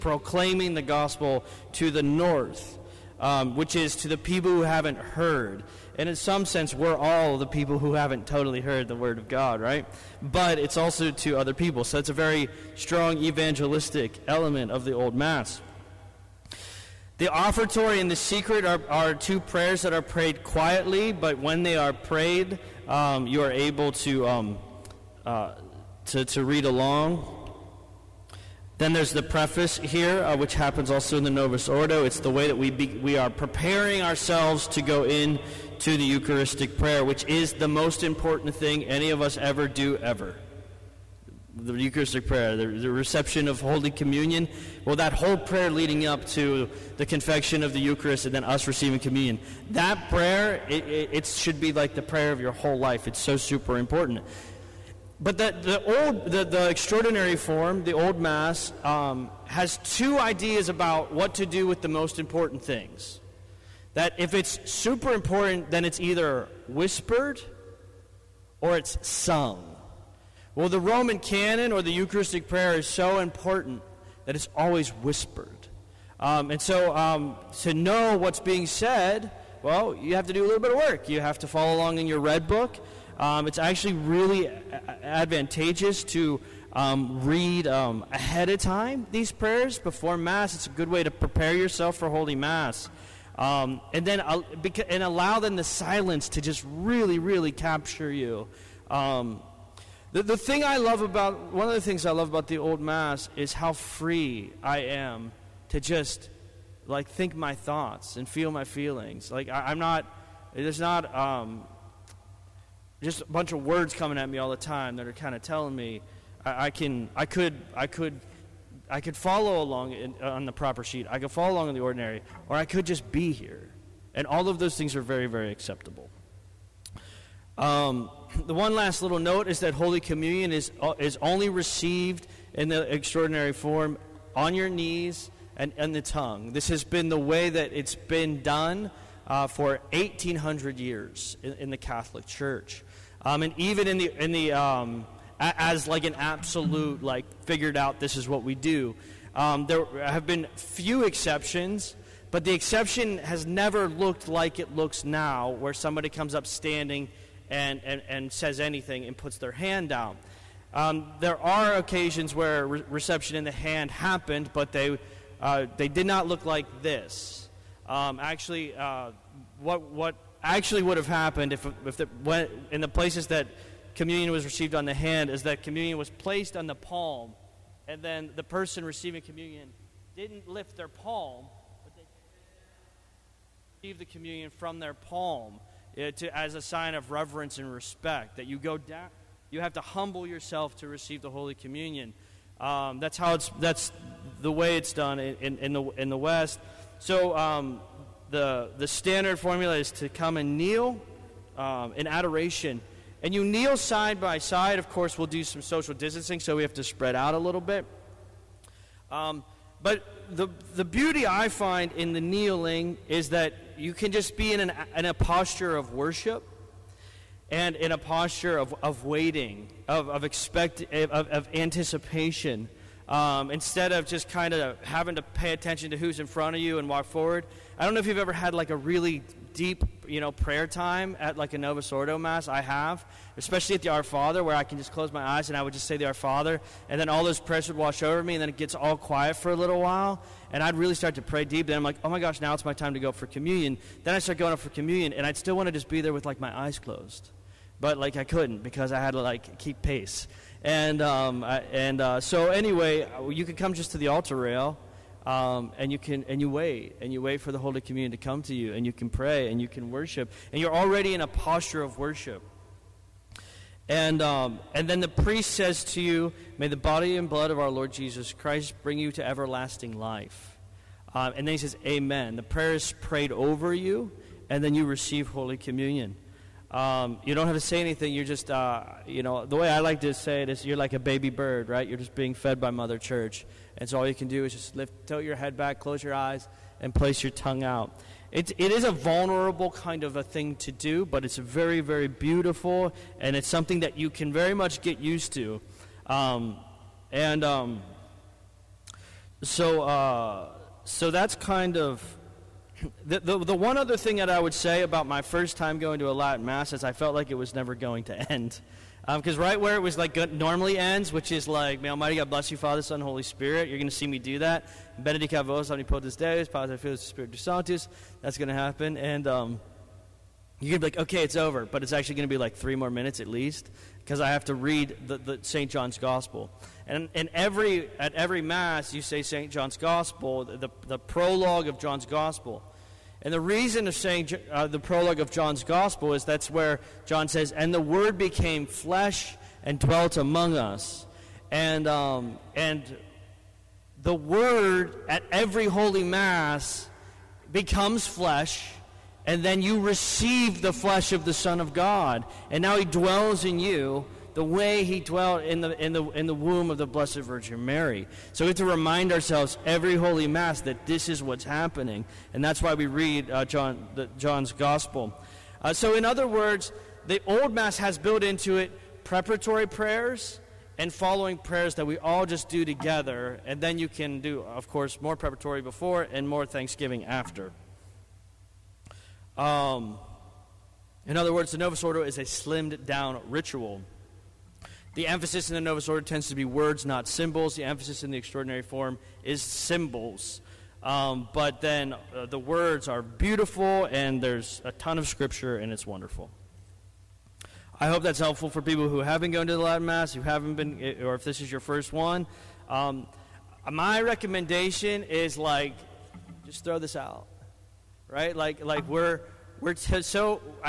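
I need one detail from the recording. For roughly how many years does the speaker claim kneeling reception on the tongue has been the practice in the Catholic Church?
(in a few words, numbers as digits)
1,800.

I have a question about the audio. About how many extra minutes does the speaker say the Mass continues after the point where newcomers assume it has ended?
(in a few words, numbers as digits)
3.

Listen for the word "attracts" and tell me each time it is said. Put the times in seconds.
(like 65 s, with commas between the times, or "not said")
not said.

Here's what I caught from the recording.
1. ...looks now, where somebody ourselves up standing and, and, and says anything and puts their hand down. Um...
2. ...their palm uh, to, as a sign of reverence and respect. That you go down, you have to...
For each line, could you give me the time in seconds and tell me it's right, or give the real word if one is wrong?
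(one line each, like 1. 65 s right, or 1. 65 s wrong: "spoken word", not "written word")
1. 154 s wrong: "comes", not "ourselves"
2. 184 s right.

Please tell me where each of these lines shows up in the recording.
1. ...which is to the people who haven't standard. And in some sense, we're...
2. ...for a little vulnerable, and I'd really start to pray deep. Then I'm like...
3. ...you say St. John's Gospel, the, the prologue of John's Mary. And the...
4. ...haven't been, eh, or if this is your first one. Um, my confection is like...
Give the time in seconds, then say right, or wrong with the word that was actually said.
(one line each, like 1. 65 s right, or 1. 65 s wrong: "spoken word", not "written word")
1. 3 s wrong: "heard", not "standard"
2. 239 s wrong: "while", not "vulnerable"
3. 328 s wrong: "Gospel", not "Mary"
4. 400 s wrong: "recommendation", not "confection".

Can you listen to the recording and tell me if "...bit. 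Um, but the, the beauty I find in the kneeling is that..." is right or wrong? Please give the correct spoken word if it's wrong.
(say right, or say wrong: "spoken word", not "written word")
right.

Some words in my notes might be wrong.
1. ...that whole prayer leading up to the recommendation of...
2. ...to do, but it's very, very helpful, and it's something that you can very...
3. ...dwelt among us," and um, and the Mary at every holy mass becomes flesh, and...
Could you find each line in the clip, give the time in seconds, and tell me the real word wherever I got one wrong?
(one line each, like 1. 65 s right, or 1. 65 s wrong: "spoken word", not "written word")
1. 44 s wrong: "confection", not "recommendation"
2. 290 s wrong: "beautiful", not "helpful"
3. 339 s wrong: "Word", not "Mary".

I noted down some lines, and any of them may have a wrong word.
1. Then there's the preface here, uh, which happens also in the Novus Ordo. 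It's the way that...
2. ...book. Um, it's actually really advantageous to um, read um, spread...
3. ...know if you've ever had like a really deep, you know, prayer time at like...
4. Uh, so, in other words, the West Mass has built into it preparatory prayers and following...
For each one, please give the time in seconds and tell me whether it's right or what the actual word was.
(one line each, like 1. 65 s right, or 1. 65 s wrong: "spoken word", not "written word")
1. 28 s right
2. 82 s wrong: "ahead", not "spread"
3. 227 s right
4. 365 s wrong: "Old", not "West".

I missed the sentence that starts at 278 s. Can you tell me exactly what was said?
You're just, uh, you know, the way I like to say it is you're like a baby bird, right?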